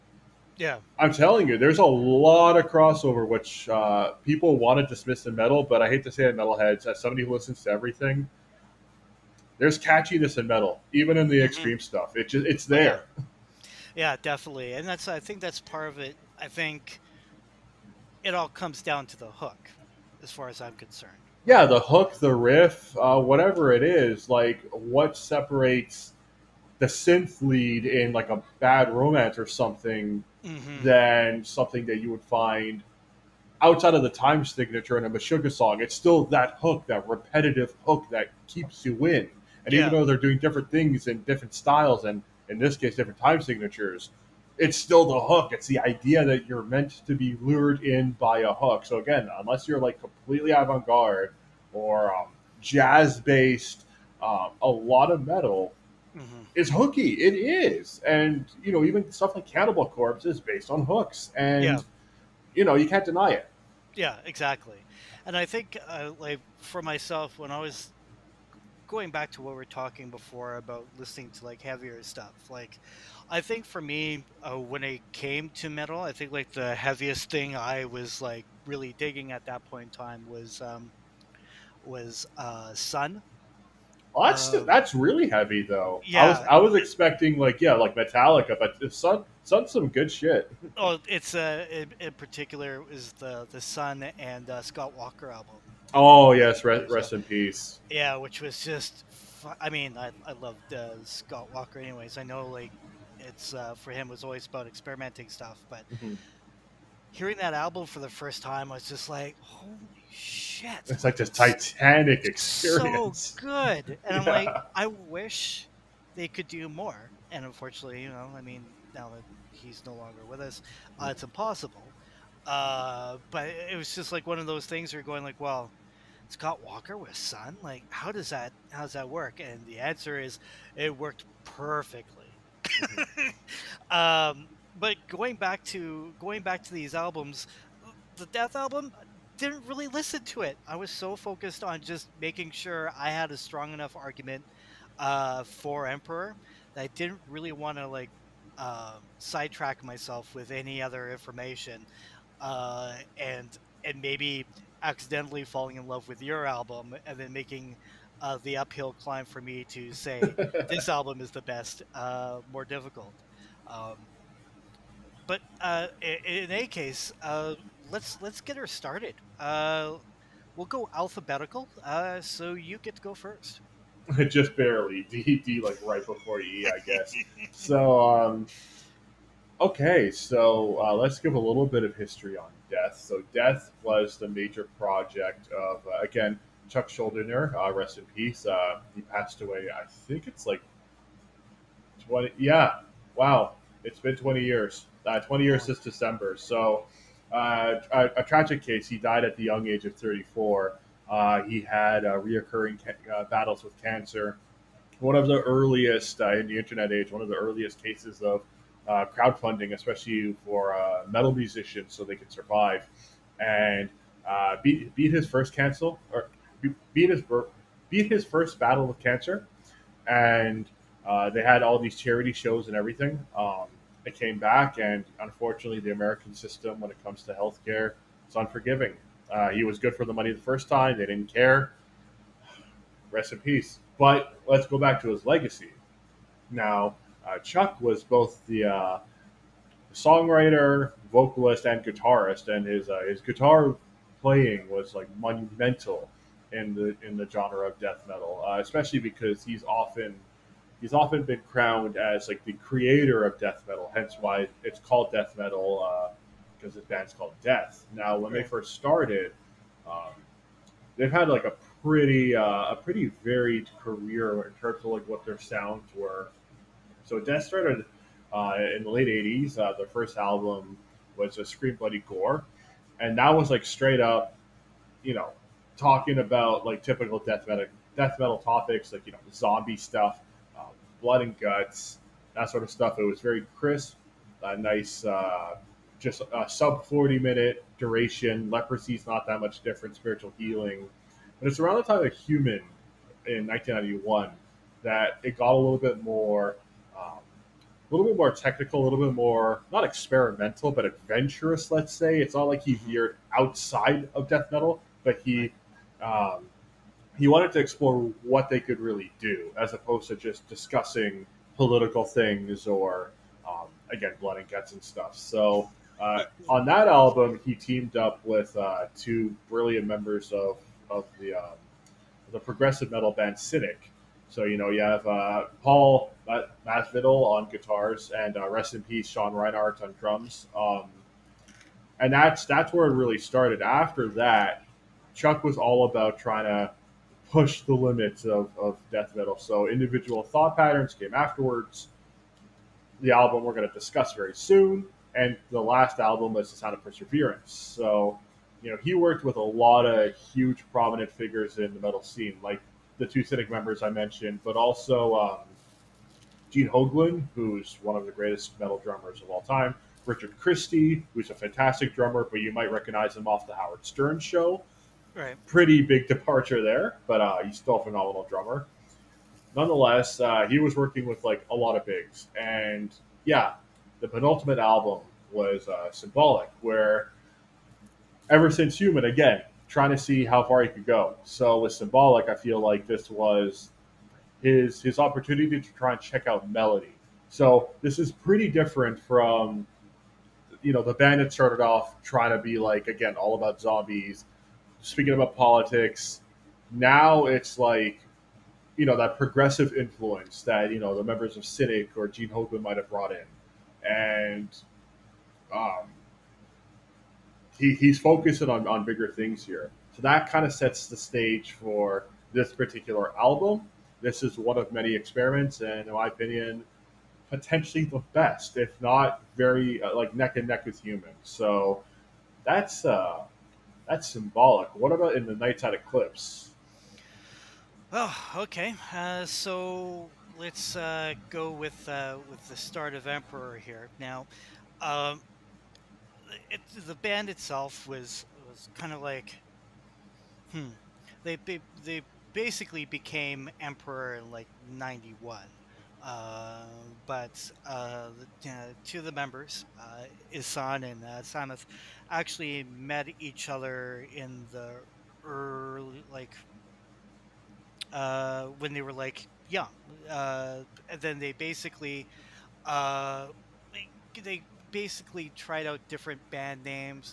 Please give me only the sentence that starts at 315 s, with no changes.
So uh, on that album, he teamed up with uh, two brilliant members of, of the, um, the progressive metal band Cynic.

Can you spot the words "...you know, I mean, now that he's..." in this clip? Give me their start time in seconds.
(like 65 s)
118 s.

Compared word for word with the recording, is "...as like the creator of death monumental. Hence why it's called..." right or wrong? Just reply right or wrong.
wrong.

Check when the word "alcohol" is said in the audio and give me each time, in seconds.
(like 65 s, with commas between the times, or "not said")
not said.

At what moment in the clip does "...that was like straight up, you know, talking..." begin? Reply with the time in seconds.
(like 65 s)
273 s.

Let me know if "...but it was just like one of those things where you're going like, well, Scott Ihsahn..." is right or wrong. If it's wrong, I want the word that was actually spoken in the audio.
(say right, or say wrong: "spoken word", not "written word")
wrong: "Walker", not "Ihsahn".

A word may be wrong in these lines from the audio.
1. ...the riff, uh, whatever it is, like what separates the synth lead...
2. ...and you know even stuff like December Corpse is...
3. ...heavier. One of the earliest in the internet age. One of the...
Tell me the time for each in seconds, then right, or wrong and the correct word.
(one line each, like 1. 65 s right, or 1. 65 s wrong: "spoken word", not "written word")
1. 22 s right
2. 58 s wrong: "Cannibal", not "December"
3. 203 s wrong: "cancer", not "heavier".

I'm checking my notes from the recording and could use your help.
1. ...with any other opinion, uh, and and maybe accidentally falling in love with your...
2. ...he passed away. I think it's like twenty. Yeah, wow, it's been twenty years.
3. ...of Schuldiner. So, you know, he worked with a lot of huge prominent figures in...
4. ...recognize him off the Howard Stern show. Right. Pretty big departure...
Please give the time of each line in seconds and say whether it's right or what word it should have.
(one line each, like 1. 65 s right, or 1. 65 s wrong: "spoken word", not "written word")
1. 150 s wrong: "information", not "opinion"
2. 188 s right
3. 346 s wrong: "Perseverance", not "Schuldiner"
4. 362 s right.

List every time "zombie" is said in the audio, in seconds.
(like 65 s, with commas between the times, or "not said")
279 s, 393 s.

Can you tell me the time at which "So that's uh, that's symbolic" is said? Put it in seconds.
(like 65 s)
421 s.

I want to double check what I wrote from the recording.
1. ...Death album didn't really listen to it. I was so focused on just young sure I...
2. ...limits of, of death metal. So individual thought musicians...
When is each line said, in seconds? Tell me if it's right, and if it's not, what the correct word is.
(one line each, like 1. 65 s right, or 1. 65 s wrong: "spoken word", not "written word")
1. 138 s wrong: "making", not "young"
2. 337 s wrong: "patterns", not "musicians".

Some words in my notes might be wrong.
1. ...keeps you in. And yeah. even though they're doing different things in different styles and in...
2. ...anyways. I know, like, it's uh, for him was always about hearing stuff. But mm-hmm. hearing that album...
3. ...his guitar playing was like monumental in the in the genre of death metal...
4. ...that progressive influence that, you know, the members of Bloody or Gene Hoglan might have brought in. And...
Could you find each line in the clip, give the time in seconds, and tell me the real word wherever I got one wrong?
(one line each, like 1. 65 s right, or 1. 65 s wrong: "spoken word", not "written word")
1. 38 s right
2. 101 s wrong: "experimenting", not "hearing"
3. 243 s right
4. 398 s wrong: "Cynic", not "Bloody".